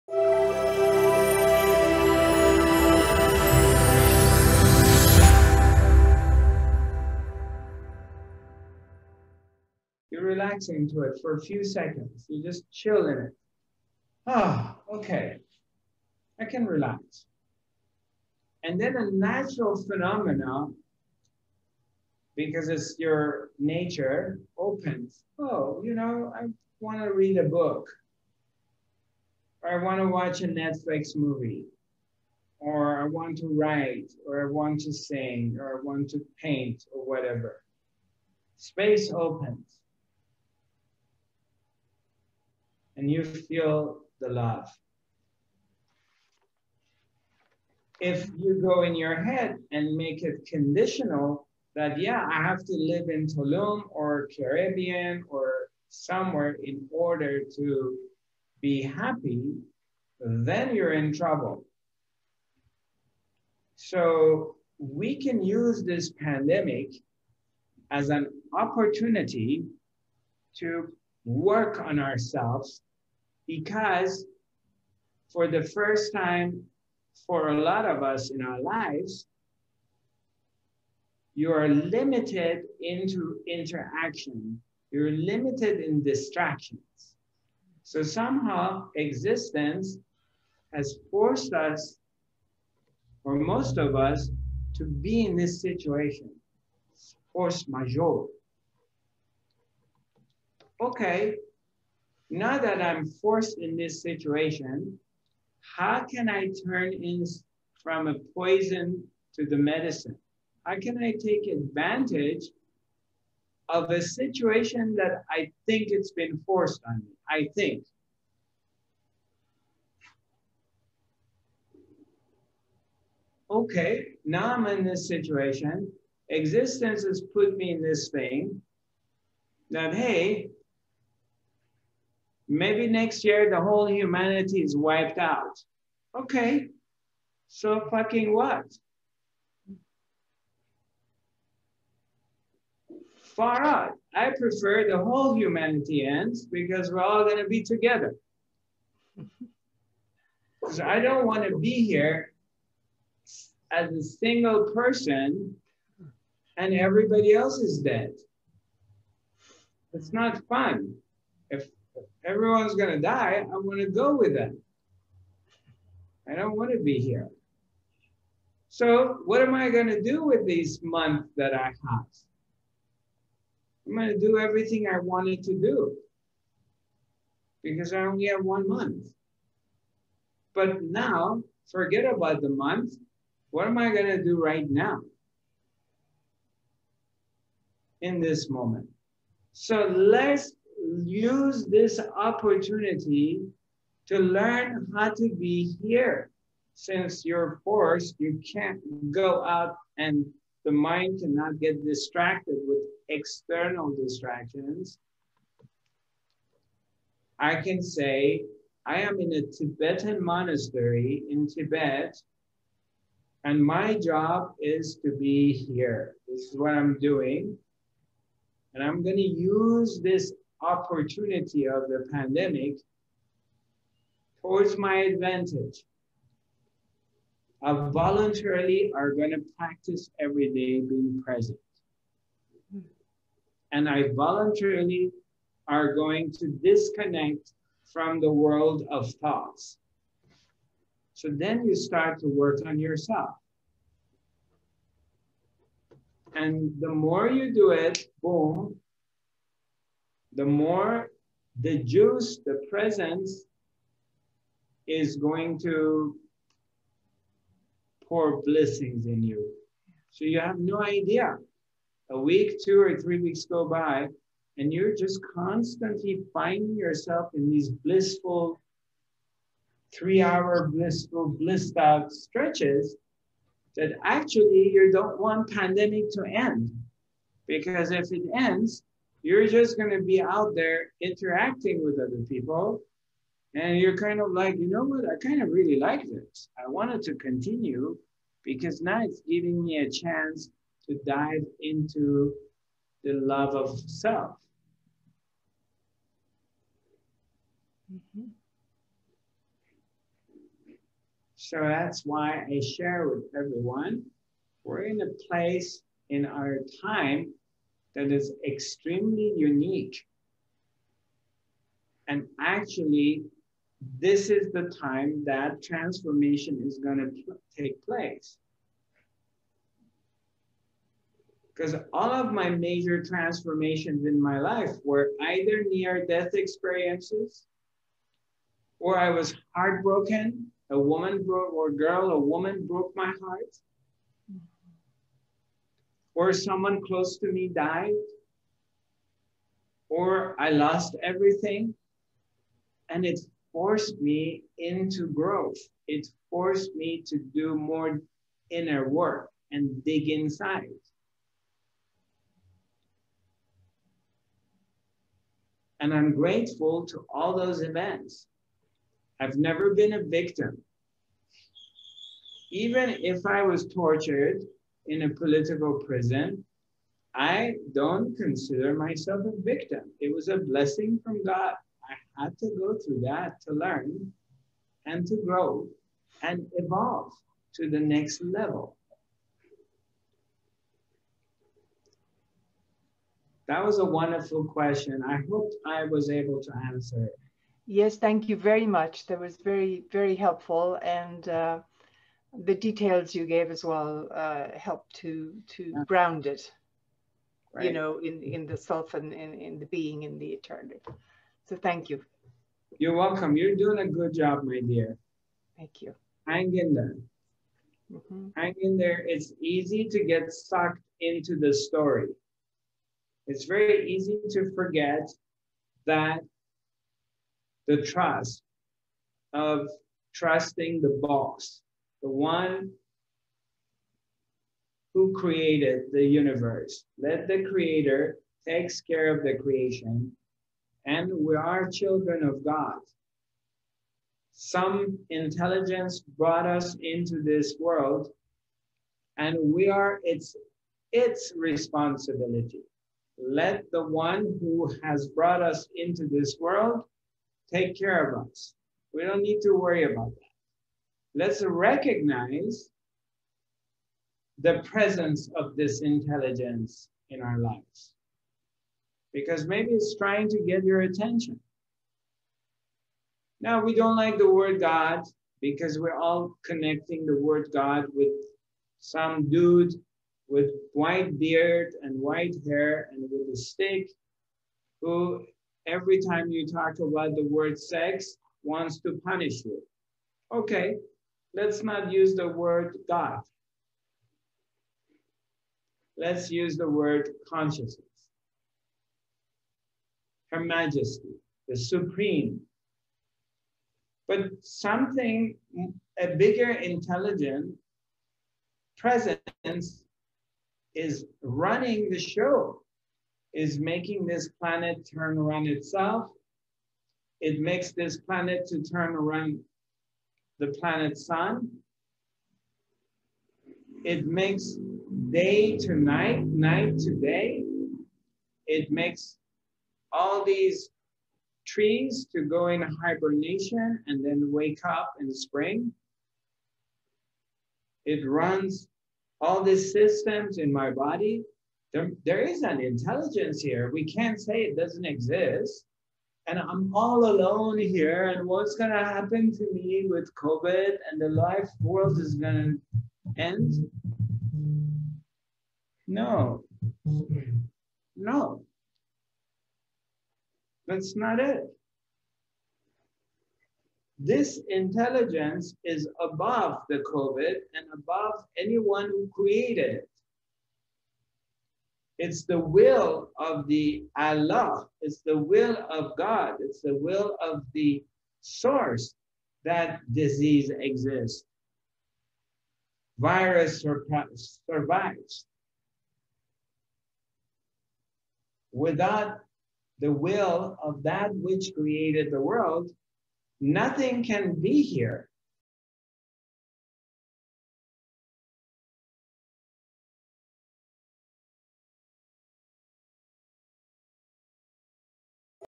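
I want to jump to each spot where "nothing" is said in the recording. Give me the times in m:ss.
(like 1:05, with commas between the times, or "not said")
9:43.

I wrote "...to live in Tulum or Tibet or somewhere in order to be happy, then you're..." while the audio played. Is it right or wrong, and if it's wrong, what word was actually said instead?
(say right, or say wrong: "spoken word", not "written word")
wrong: "Caribbean", not "Tibet".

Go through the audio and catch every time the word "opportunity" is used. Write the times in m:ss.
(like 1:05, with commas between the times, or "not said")
1:08, 3:12, 3:40.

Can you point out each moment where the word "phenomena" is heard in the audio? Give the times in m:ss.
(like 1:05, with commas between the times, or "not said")
0:19.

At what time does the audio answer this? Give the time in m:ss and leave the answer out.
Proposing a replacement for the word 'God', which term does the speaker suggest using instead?
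8:07.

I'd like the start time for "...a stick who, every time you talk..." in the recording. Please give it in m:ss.
7:53.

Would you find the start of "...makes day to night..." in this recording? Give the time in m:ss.
8:34.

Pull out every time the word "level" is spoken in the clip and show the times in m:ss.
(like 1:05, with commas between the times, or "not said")
6:18.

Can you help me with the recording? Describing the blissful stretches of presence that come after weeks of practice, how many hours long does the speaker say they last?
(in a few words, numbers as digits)
3 hours.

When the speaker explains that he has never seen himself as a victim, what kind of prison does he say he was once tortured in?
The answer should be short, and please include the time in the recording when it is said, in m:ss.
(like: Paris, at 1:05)
a political prison, at 6:05.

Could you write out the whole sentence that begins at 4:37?
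Because if it ends, you're just going to be out there interacting with other people.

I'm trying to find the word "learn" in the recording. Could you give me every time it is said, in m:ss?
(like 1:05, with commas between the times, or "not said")
3:14, 6:13.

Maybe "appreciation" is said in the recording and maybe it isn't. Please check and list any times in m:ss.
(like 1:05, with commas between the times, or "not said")
not said.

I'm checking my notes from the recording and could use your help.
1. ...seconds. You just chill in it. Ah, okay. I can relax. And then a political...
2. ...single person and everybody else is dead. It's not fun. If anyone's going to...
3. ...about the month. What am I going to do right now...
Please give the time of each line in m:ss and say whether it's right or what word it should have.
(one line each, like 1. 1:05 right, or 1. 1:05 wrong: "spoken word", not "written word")
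1. 0:11 wrong: "natural", not "political"
2. 2:34 wrong: "everyone", not "anyone"
3. 3:02 right.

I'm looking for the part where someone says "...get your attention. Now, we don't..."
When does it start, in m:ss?
7:40.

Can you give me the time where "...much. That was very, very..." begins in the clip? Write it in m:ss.
6:28.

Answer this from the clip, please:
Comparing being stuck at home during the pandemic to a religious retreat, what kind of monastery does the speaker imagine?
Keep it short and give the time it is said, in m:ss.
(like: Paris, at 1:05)
Tibetan monastery, at 3:29.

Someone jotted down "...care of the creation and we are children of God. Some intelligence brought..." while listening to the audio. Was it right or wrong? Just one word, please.
right.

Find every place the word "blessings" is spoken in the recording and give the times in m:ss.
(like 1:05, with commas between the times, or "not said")
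4:18, 6:10.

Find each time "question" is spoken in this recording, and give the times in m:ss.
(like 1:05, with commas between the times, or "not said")
6:24.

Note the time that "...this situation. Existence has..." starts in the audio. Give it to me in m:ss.
2:04.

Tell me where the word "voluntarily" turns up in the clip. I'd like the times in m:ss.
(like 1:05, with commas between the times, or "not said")
3:47, 3:54.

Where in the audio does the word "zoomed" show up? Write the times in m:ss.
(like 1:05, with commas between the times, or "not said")
not said.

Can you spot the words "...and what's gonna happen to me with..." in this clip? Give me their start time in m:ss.
8:58.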